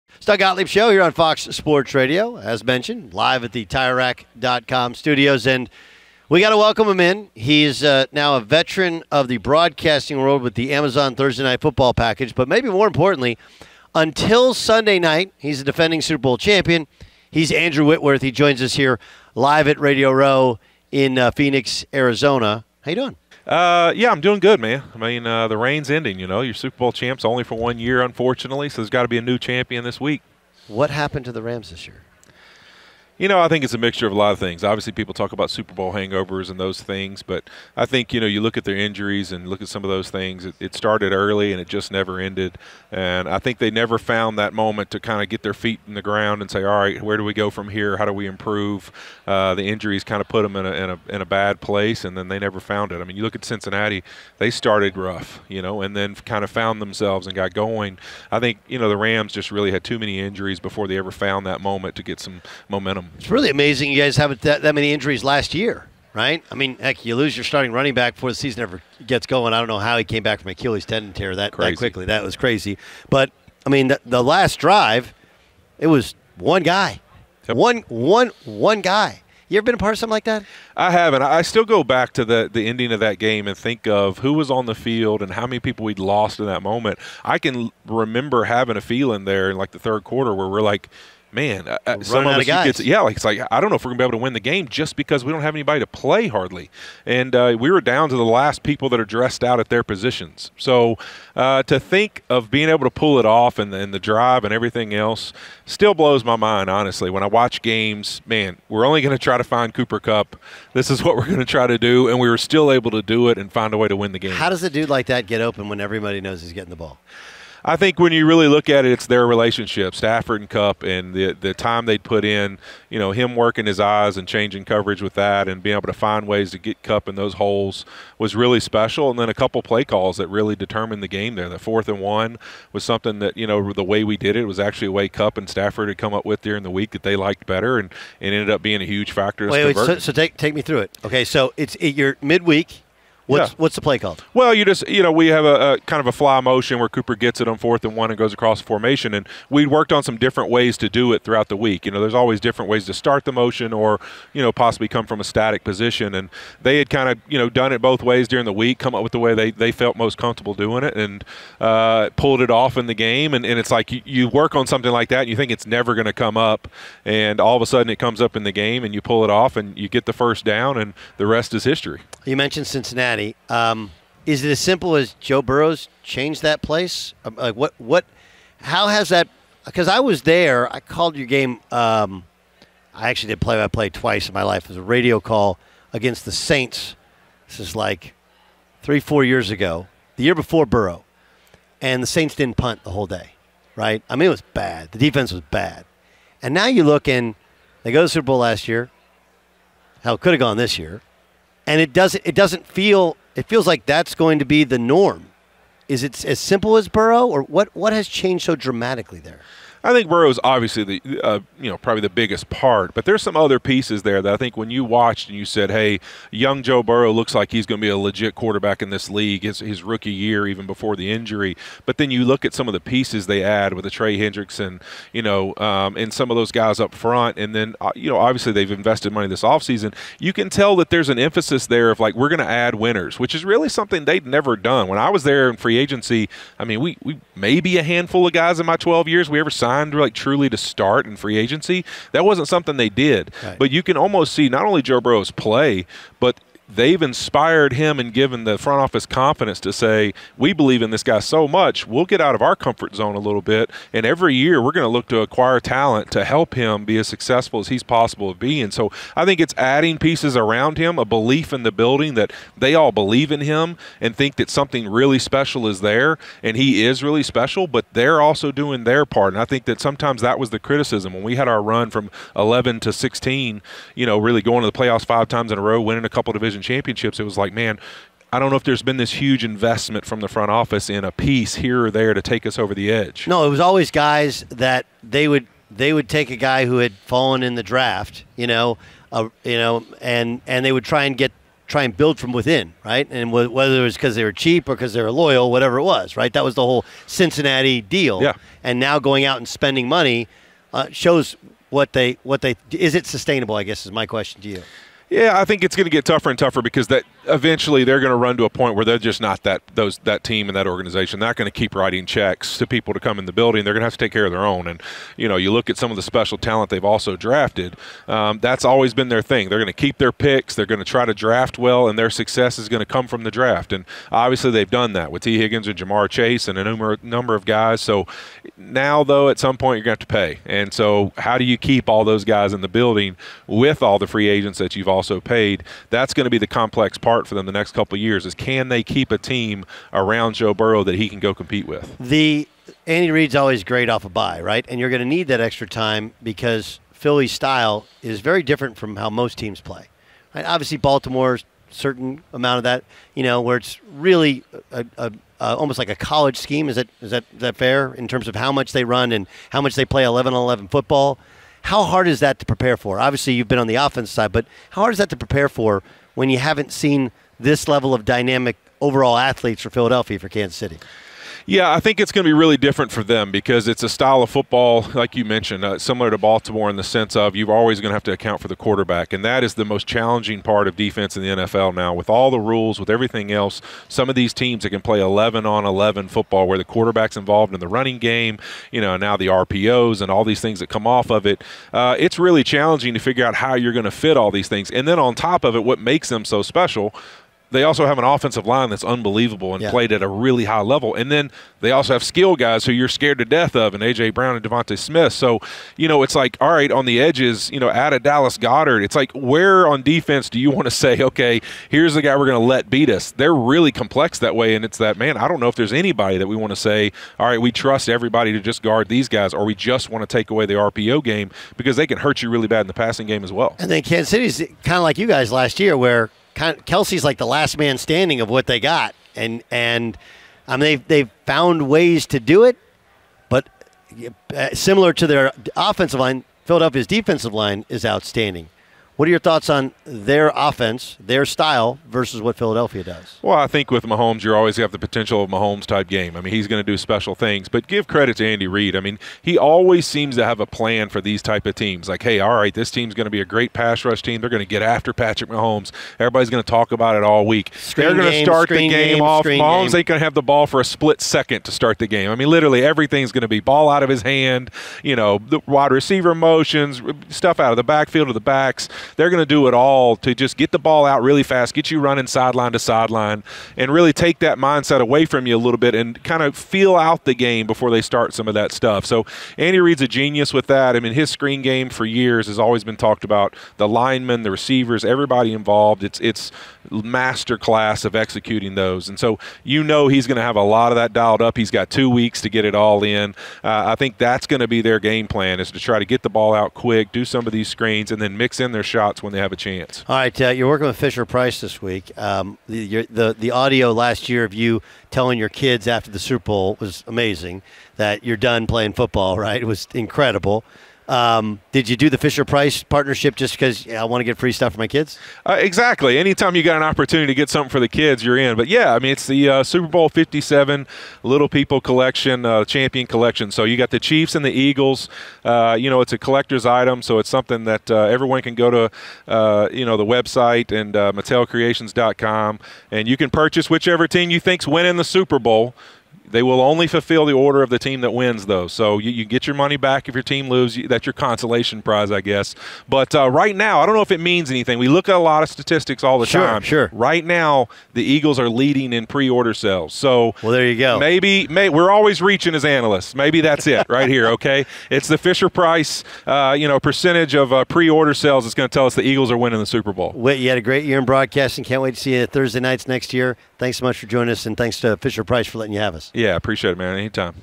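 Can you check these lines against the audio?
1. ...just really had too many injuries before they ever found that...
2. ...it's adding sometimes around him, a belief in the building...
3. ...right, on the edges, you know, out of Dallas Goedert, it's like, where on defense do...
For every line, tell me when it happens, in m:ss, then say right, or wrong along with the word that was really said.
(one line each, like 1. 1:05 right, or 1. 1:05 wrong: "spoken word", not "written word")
1. 0:59 right
2. 4:19 wrong: "pieces", not "sometimes"
3. 6:46 right.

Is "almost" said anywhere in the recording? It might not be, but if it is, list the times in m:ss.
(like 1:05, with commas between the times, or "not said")
4:03, 5:55.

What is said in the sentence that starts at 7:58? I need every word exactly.
So Andy Reid's a genius with that.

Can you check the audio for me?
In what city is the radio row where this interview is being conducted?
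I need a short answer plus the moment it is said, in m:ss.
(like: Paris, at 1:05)
Phoenix, at 0:21.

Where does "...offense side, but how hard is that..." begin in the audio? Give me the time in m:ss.
6:03.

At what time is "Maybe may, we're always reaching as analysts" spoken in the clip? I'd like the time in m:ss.
9:10.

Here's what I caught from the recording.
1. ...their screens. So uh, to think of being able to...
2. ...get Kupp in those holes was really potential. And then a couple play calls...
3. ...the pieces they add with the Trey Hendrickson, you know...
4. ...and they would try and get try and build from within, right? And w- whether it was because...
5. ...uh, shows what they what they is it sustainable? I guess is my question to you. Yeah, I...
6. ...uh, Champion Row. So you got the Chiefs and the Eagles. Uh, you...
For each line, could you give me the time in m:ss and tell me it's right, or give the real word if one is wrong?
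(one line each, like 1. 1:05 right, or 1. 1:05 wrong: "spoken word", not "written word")
1. 1:39 wrong: "positions", not "screens"
2. 2:06 wrong: "special", not "potential"
3. 3:42 right
4. 4:50 right
5. 5:00 right
6. 8:42 wrong: "Collection", not "Row".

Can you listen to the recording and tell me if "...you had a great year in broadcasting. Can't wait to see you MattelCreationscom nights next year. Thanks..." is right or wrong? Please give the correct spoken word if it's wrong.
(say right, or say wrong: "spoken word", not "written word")
wrong: "Thursday", not "MattelCreationscom".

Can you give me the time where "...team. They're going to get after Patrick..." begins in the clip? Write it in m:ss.
7:34.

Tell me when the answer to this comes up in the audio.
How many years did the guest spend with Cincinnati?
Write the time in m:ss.
3:58.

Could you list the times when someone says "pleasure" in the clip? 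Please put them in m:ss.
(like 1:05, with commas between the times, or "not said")
not said.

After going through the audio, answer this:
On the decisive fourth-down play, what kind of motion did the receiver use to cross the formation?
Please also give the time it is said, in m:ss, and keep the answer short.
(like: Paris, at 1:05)
Fly motion, at 2:26.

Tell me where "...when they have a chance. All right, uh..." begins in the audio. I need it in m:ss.
8:19.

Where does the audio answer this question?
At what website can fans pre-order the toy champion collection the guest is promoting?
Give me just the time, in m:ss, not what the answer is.
8:50.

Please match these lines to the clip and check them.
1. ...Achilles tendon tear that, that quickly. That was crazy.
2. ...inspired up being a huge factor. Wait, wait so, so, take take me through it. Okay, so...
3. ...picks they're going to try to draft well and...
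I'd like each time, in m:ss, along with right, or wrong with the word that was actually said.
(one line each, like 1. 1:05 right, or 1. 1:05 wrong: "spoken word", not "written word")
1. 1:10 right
2. 2:18 wrong: "ended", not "inspired"
3. 5:20 right.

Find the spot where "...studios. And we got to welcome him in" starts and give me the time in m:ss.
0:04.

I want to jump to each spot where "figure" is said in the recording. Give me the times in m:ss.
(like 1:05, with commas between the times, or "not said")
6:32.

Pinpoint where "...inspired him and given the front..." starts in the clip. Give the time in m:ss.
4:07.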